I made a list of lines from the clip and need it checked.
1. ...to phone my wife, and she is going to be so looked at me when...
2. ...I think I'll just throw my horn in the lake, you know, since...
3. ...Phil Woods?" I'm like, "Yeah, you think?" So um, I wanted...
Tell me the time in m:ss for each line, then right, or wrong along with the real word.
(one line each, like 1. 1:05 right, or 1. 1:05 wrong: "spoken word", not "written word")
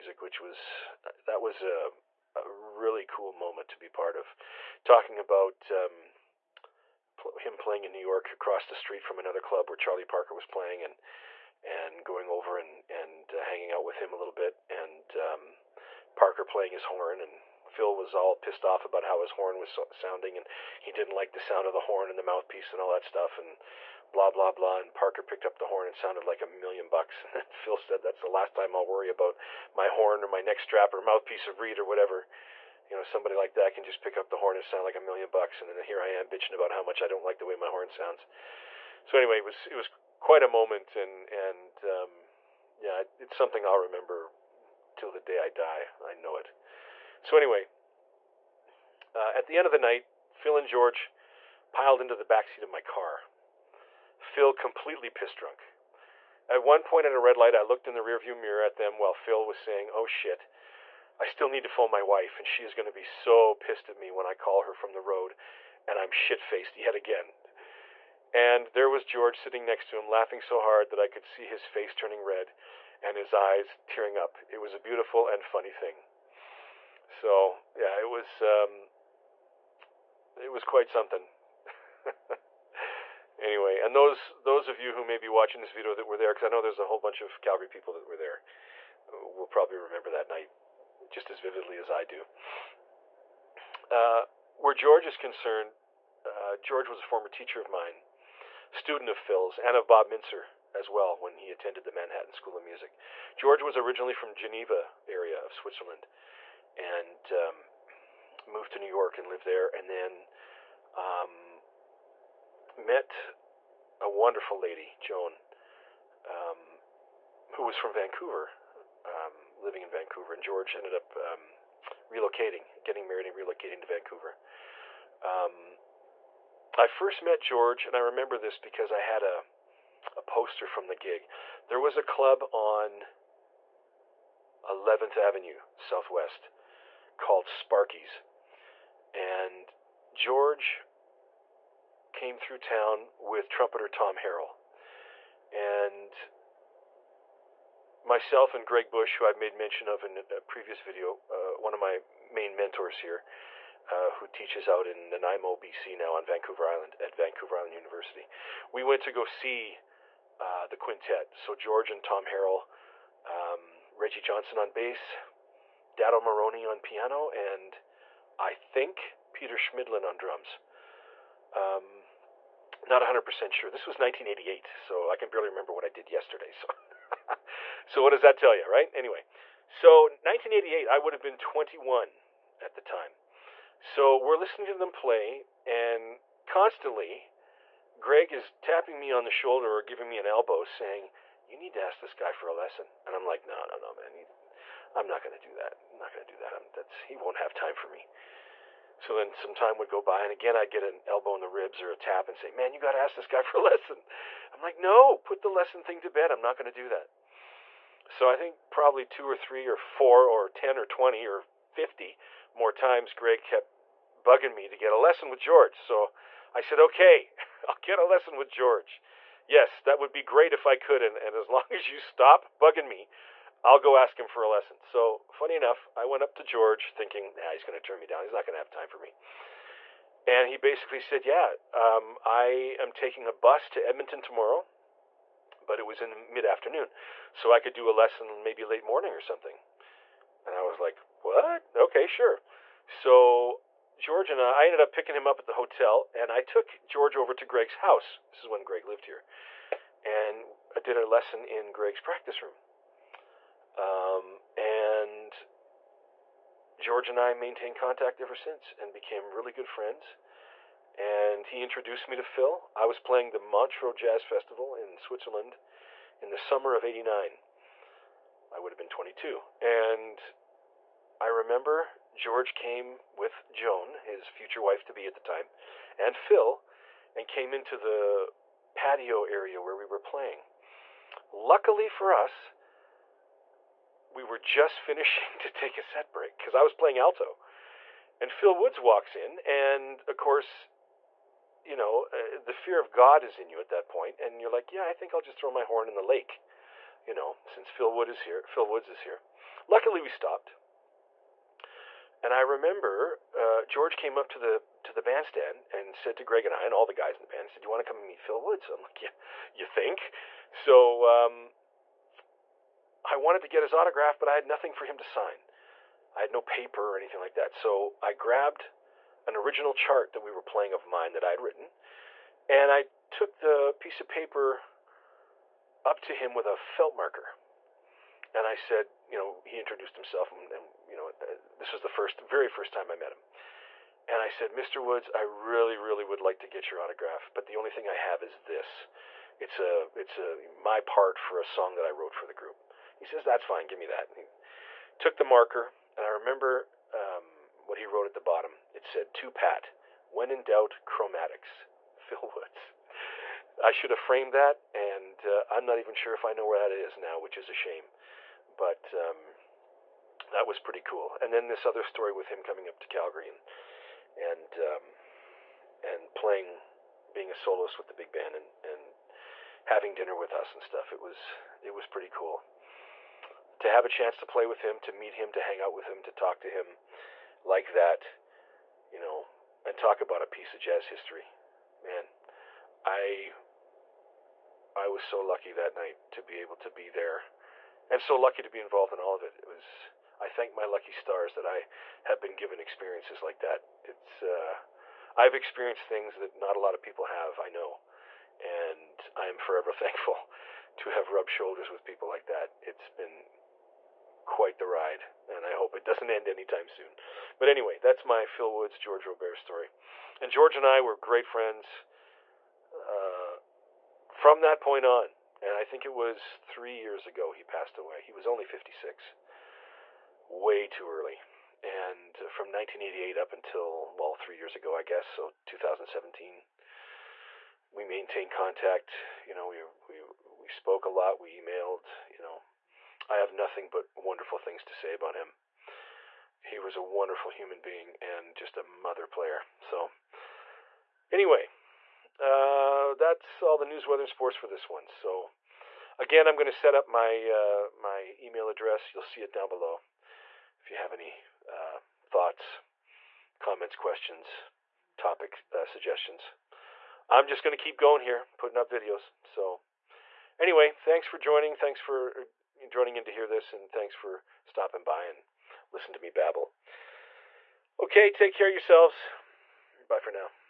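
1. 1:01 wrong: "pissed", not "looked"
2. 4:54 right
3. 5:08 right.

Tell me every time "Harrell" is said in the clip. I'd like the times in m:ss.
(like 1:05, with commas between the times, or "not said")
2:24, 2:42.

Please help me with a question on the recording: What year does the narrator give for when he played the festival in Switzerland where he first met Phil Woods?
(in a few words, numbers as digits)
1989.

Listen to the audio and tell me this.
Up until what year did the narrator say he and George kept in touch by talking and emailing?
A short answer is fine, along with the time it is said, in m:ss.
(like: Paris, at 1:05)
2017, at 7:05.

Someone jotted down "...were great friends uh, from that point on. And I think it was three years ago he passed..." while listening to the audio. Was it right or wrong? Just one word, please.
right.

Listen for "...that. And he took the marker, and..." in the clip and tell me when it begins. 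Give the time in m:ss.
5:43.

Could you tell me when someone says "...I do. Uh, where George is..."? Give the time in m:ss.
1:31.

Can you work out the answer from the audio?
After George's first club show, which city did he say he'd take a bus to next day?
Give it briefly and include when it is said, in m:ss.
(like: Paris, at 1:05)
Edmonton, at 3:53.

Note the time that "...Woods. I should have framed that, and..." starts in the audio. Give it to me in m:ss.
5:52.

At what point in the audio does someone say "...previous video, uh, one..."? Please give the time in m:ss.
2:30.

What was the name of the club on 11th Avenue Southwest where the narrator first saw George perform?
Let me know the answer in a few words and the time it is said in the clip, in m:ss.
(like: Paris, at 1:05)
Sparky's, at 2:17.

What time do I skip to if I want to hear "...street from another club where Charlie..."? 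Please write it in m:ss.
0:08.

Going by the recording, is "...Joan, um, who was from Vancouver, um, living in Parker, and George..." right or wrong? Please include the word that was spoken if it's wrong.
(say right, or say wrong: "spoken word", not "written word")
wrong: "Vancouver", not "Parker".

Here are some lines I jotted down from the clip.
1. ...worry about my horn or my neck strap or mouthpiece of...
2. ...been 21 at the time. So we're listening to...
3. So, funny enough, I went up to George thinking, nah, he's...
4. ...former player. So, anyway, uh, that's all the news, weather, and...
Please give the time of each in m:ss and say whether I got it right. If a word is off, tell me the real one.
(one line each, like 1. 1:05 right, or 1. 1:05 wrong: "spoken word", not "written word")
1. 0:28 right
2. 3:01 right
3. 3:44 right
4. 7:18 wrong: "mother", not "former".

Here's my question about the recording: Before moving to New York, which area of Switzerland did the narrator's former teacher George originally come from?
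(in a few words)
Geneva.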